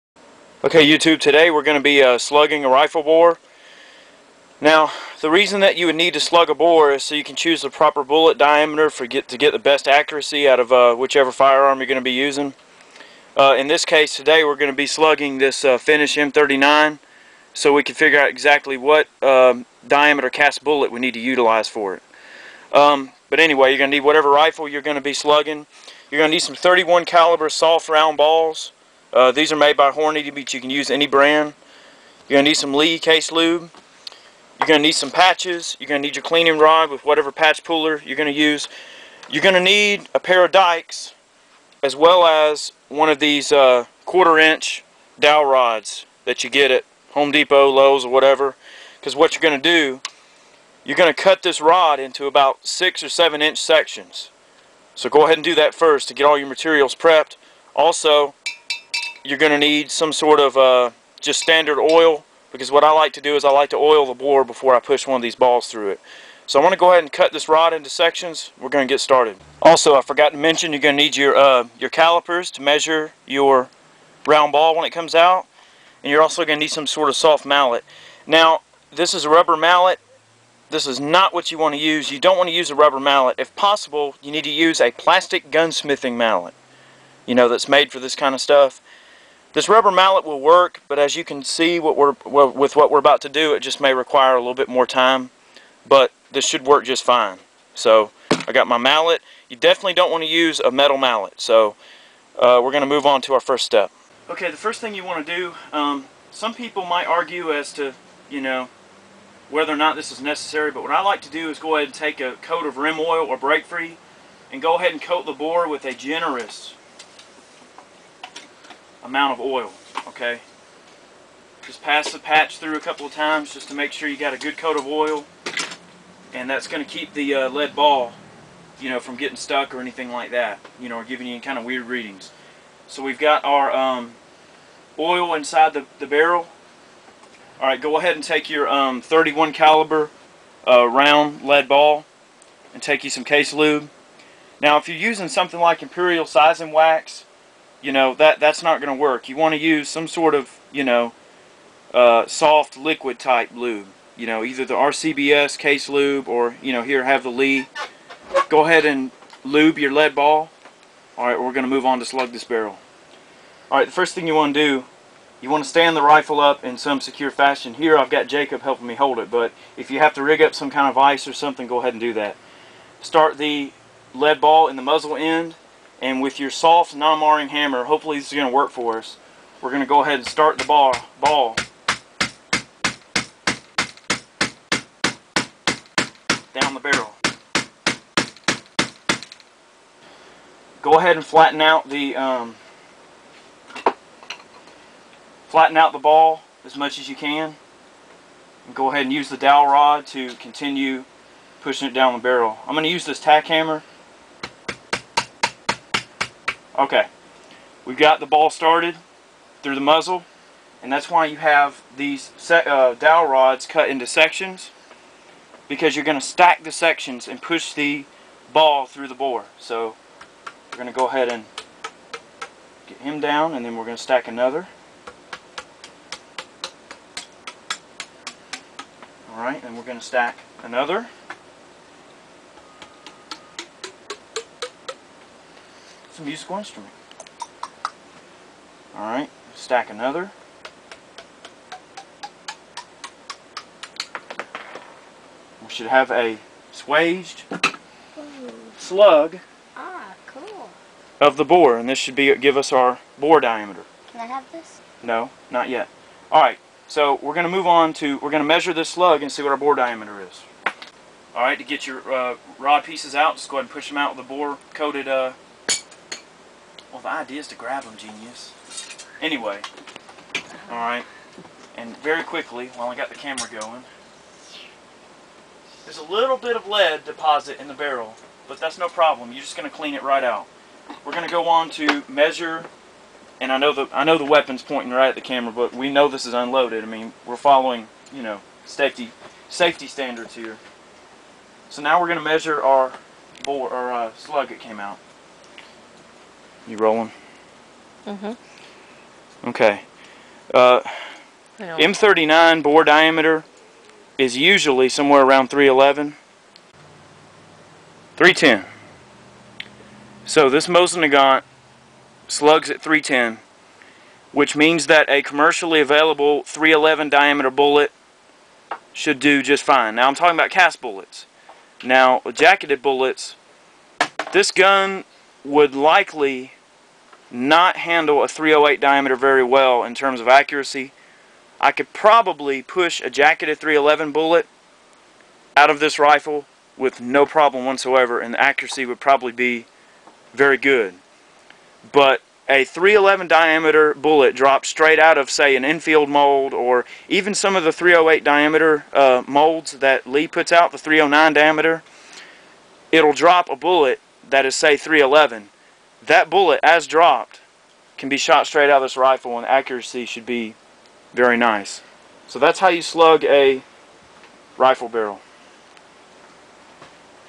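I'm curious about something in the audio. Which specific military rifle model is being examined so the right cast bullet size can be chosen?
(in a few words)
Finnish M39.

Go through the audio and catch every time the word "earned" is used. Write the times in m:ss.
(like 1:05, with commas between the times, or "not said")
not said.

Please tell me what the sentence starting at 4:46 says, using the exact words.
I mean, we're following you know safety safety standards here.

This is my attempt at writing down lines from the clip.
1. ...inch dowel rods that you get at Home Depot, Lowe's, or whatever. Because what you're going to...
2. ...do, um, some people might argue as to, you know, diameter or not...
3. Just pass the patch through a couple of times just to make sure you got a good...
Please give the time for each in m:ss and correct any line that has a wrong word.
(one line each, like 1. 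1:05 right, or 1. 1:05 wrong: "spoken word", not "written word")
1. 0:44 right
2. 1:45 wrong: "whether", not "diameter"
3. 2:01 right.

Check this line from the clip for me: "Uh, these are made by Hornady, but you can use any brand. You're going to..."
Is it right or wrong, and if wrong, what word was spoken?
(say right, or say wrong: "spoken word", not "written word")
right.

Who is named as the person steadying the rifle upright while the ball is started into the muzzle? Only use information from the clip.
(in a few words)
Jacob.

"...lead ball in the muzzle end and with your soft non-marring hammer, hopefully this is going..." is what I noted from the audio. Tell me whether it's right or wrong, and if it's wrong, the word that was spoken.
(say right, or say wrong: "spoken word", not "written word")
right.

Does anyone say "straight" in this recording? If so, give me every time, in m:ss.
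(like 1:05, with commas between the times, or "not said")
5:44, 5:58.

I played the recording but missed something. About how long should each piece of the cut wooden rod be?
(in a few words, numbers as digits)
six or seven inch.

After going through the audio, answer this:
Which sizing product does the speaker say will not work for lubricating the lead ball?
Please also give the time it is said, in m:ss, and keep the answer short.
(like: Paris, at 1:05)
Imperial Sizing Wax, at 2:25.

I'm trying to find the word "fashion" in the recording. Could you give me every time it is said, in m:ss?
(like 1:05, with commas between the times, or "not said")
2:47.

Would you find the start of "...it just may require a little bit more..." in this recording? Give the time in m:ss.
1:33.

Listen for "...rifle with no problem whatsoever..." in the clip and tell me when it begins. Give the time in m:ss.
5:35.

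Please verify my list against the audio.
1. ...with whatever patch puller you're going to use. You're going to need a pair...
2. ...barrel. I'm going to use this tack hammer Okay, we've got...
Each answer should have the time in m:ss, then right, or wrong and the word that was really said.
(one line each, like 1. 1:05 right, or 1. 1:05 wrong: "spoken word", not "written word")
1. 0:36 right
2. 3:22 right.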